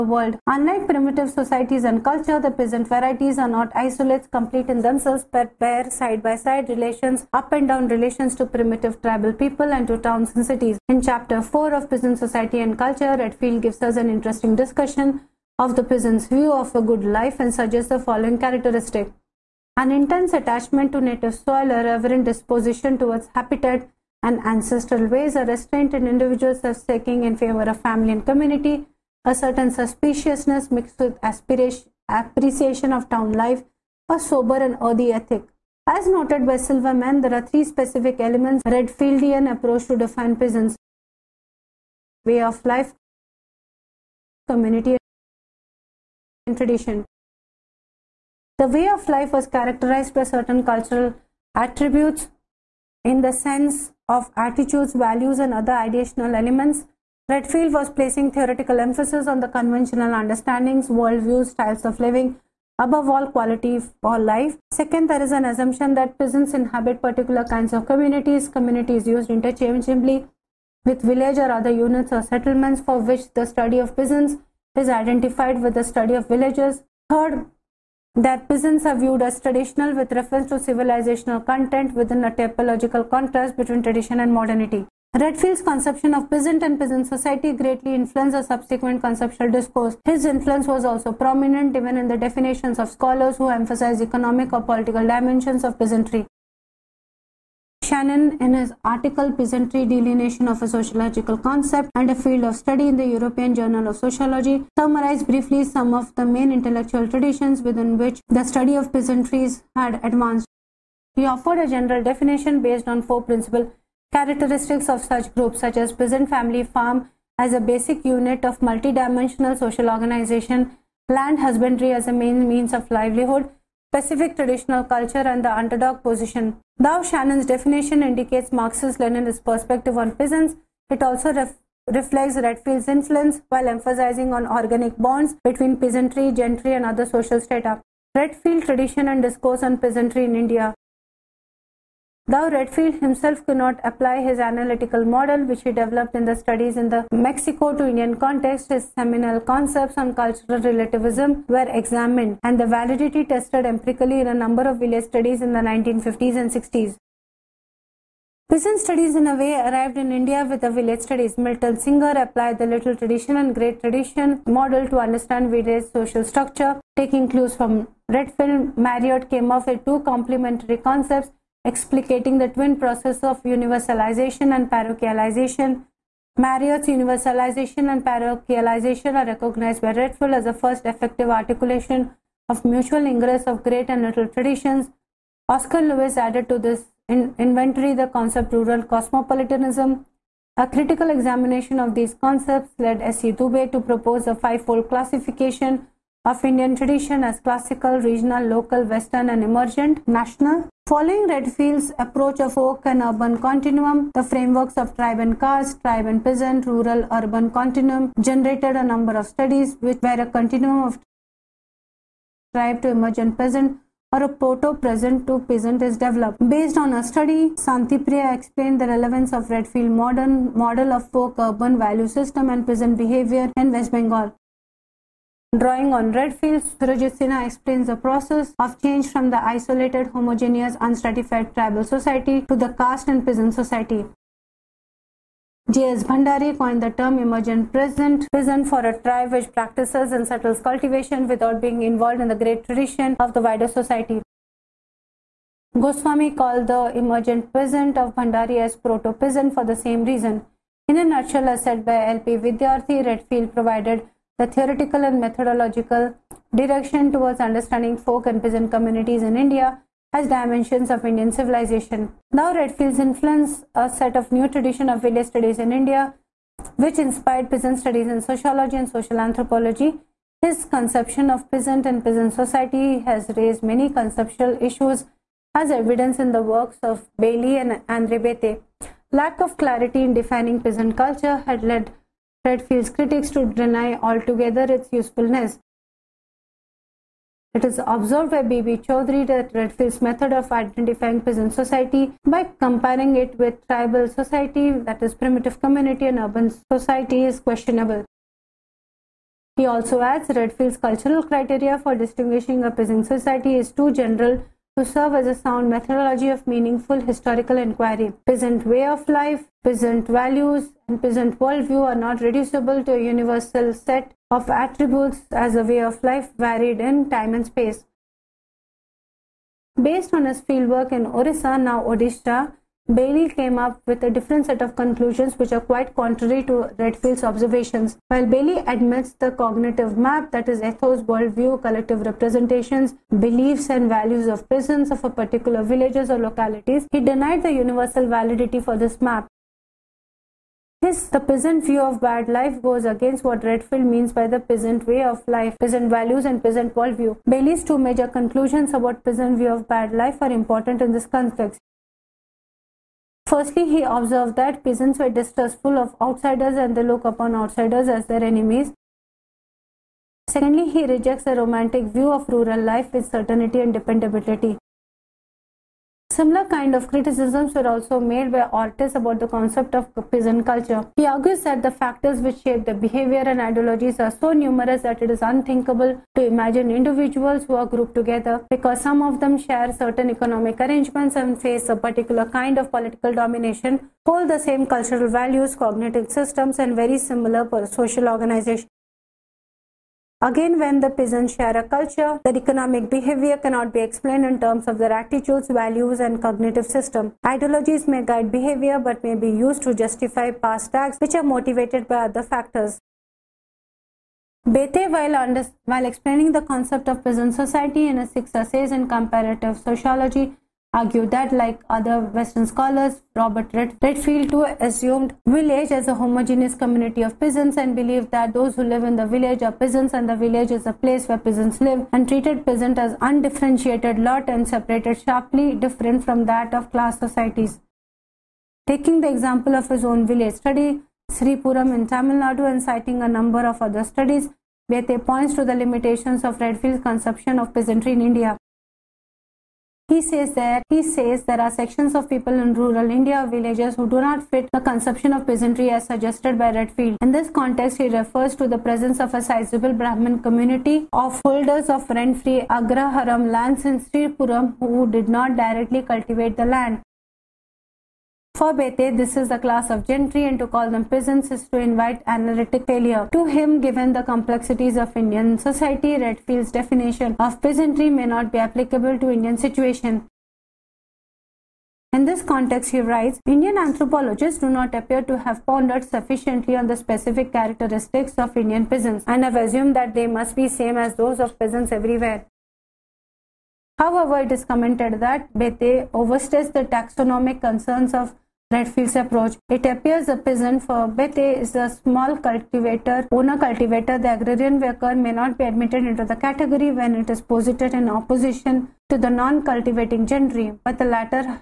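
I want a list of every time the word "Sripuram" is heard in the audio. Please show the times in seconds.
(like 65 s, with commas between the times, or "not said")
431 s, 453 s.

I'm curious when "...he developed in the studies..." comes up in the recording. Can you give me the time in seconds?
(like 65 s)
145 s.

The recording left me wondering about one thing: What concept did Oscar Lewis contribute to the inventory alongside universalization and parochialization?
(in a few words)
rural cosmopolitanism.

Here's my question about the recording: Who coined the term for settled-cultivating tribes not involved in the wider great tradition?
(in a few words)
J.S. Bhandari.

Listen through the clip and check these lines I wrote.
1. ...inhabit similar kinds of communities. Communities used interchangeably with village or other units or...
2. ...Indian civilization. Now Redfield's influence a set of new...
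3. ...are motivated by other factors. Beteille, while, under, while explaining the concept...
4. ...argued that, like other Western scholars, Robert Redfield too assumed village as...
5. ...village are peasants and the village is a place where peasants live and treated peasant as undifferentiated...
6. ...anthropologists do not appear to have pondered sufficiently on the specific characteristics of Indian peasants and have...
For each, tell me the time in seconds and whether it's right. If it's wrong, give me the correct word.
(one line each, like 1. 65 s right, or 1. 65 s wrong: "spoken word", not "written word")
1. 66 s wrong: "particular", not "similar"
2. 261 s right
3. 401 s right
4. 410 s right
5. 419 s right
6. 473 s right.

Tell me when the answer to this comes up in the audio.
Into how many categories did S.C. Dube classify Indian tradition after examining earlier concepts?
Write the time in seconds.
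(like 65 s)
194 s.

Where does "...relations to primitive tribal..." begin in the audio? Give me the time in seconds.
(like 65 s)
7 s.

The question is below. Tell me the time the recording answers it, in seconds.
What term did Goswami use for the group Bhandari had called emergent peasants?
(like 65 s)
248 s.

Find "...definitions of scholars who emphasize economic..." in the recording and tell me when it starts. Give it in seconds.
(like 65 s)
92 s.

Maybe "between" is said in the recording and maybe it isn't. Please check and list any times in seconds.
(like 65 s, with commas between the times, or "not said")
83 s, 135 s.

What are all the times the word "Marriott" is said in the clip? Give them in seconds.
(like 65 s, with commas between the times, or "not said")
168 s, 176 s.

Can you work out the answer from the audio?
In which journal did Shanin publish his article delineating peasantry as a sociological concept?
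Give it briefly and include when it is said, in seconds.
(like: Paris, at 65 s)
European Journal of Sociology, at 103 s.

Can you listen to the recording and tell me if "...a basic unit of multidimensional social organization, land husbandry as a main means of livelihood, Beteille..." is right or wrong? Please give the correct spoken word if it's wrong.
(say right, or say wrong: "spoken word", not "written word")
wrong: "Pacific", not "Beteille".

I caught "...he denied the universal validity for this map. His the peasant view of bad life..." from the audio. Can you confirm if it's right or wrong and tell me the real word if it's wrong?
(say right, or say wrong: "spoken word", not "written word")
right.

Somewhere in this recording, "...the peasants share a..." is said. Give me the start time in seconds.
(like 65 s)
390 s.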